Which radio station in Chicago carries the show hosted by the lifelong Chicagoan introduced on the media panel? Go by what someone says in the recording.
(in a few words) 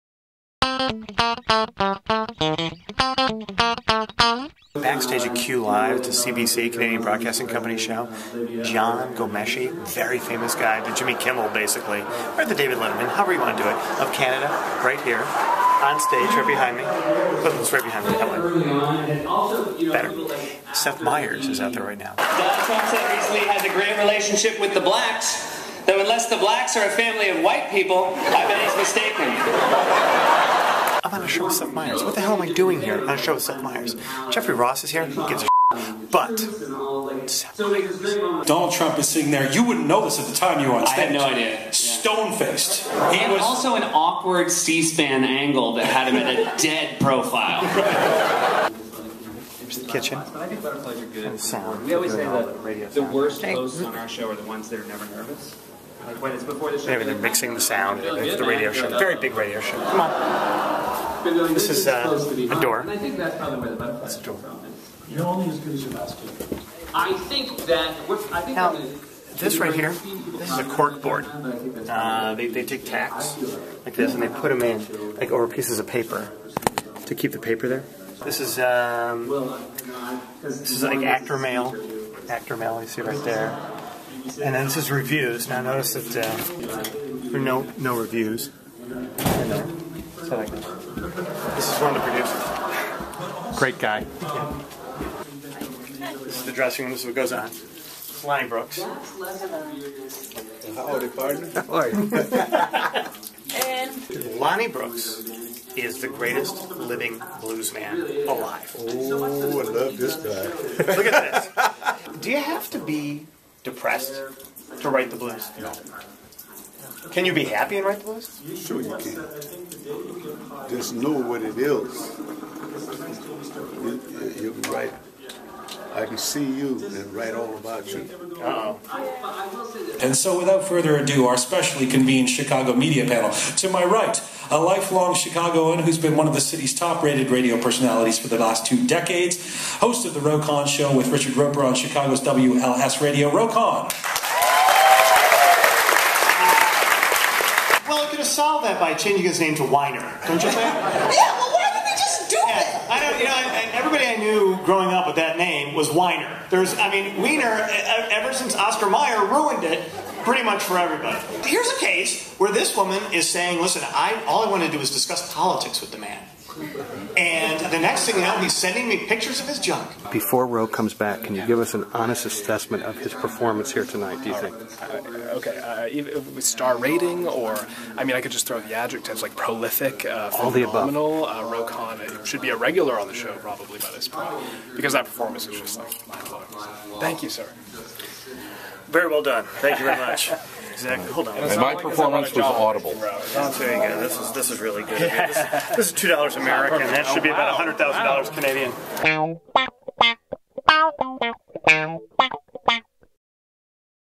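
WLS.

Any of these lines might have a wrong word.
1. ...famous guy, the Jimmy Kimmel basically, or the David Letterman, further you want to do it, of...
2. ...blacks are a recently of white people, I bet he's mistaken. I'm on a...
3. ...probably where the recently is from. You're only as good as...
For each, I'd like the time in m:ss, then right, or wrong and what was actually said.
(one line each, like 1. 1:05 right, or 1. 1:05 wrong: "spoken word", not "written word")
1. 0:10 wrong: "however", not "further"
2. 0:26 wrong: "family", not "recently"
3. 1:03 wrong: "butterfly", not "recently".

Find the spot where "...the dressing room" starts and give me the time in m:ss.
1:36.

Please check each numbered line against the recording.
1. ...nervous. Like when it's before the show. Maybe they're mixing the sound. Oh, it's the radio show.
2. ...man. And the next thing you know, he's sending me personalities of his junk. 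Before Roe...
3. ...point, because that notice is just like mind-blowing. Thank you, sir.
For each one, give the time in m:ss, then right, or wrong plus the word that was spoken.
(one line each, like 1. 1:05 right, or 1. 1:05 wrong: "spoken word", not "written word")
1. 0:55 right
2. 2:45 wrong: "pictures", not "personalities"
3. 3:04 wrong: "performance", not "notice".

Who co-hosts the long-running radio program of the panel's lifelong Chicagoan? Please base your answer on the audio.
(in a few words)
Richard Roeper.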